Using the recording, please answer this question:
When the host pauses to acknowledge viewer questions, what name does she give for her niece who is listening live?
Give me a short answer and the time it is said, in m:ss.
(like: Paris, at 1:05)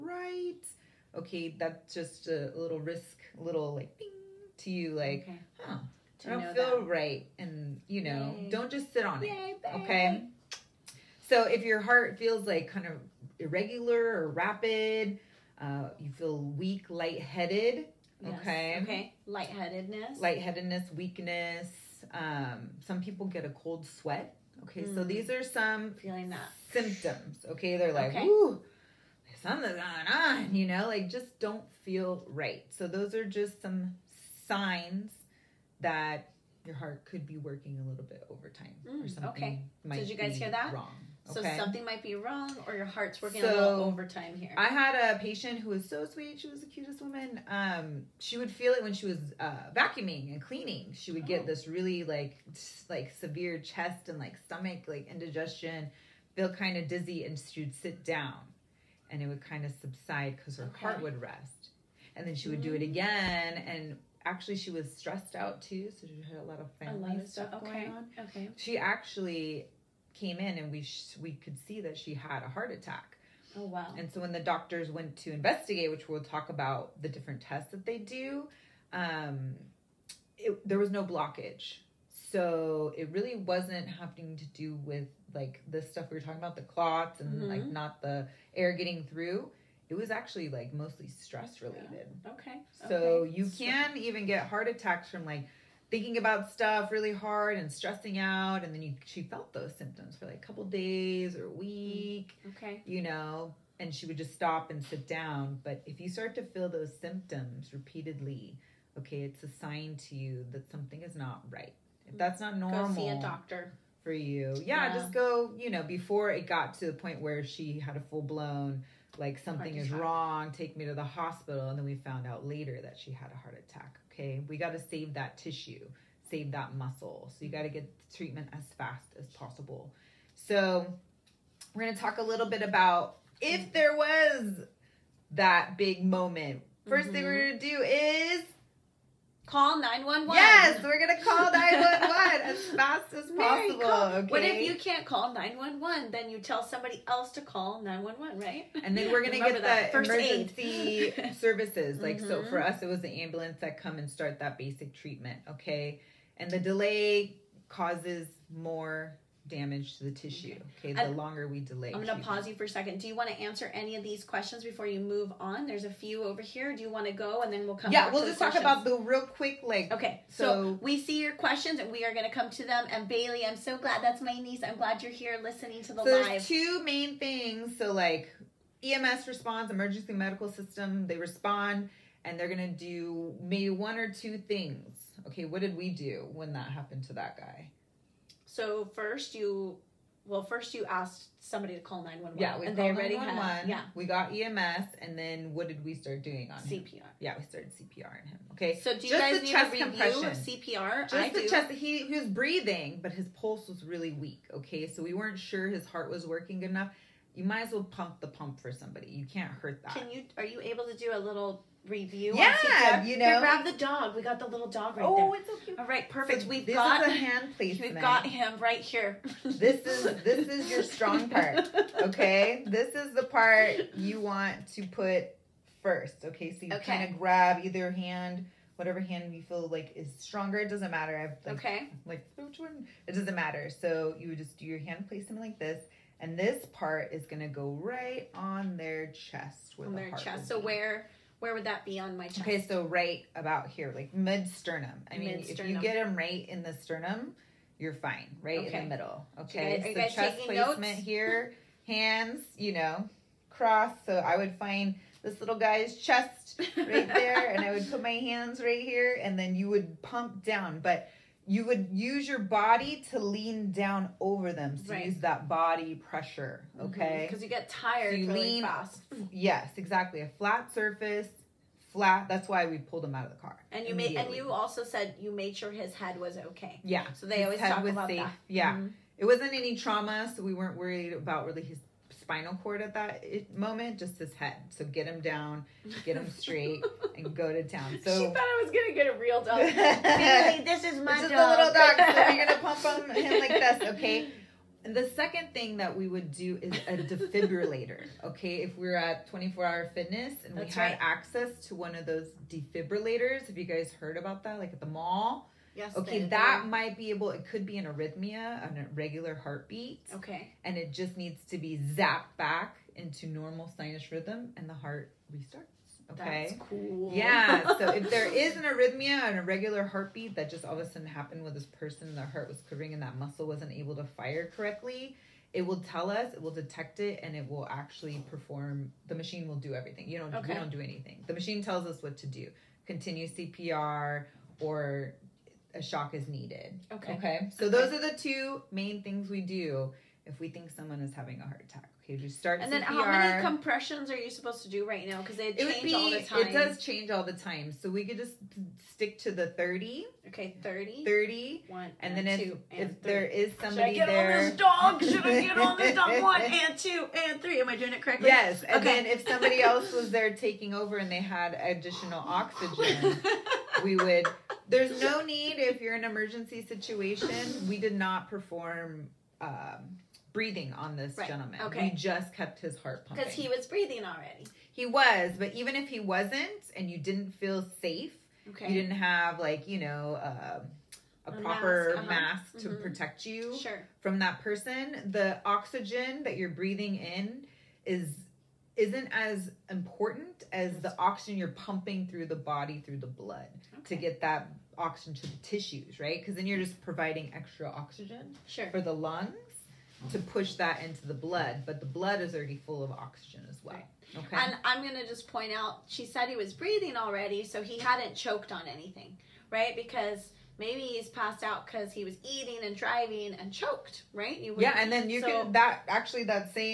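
Bailey, at 2:53.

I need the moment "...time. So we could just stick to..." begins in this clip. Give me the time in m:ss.
5:47.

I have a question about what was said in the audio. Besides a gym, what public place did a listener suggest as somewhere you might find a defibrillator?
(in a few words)
The mall.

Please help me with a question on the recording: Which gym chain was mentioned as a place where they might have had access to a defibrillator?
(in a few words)
24 Hour Fitness.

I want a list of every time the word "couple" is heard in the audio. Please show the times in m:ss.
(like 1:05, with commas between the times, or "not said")
1:40.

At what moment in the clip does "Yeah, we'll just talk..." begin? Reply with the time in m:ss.
2:47.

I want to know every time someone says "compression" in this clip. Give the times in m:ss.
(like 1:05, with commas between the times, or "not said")
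3:19, 5:43.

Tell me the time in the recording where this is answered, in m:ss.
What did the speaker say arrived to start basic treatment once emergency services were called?
2:33.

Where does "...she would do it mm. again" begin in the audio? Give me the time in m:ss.
1:02.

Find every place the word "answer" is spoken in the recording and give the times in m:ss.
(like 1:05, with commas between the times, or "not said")
2:43.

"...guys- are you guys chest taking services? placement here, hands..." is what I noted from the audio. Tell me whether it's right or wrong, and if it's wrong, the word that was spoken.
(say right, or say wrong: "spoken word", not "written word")
wrong: "notes", not "services".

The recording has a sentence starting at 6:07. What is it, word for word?
We did not perform um, breathing on this right.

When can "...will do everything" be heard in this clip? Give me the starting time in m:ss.
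5:29.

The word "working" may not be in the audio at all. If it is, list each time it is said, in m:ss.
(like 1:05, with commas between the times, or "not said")
0:37, 0:43, 3:26.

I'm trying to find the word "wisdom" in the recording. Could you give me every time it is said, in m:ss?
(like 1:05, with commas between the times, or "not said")
not said.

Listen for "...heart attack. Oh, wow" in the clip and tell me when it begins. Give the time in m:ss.
1:12.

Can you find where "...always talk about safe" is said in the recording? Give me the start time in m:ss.
4:37.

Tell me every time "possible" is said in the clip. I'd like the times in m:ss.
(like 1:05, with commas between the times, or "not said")
2:09, 2:23.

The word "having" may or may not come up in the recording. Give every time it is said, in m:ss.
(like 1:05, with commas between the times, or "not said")
1:23, 5:41.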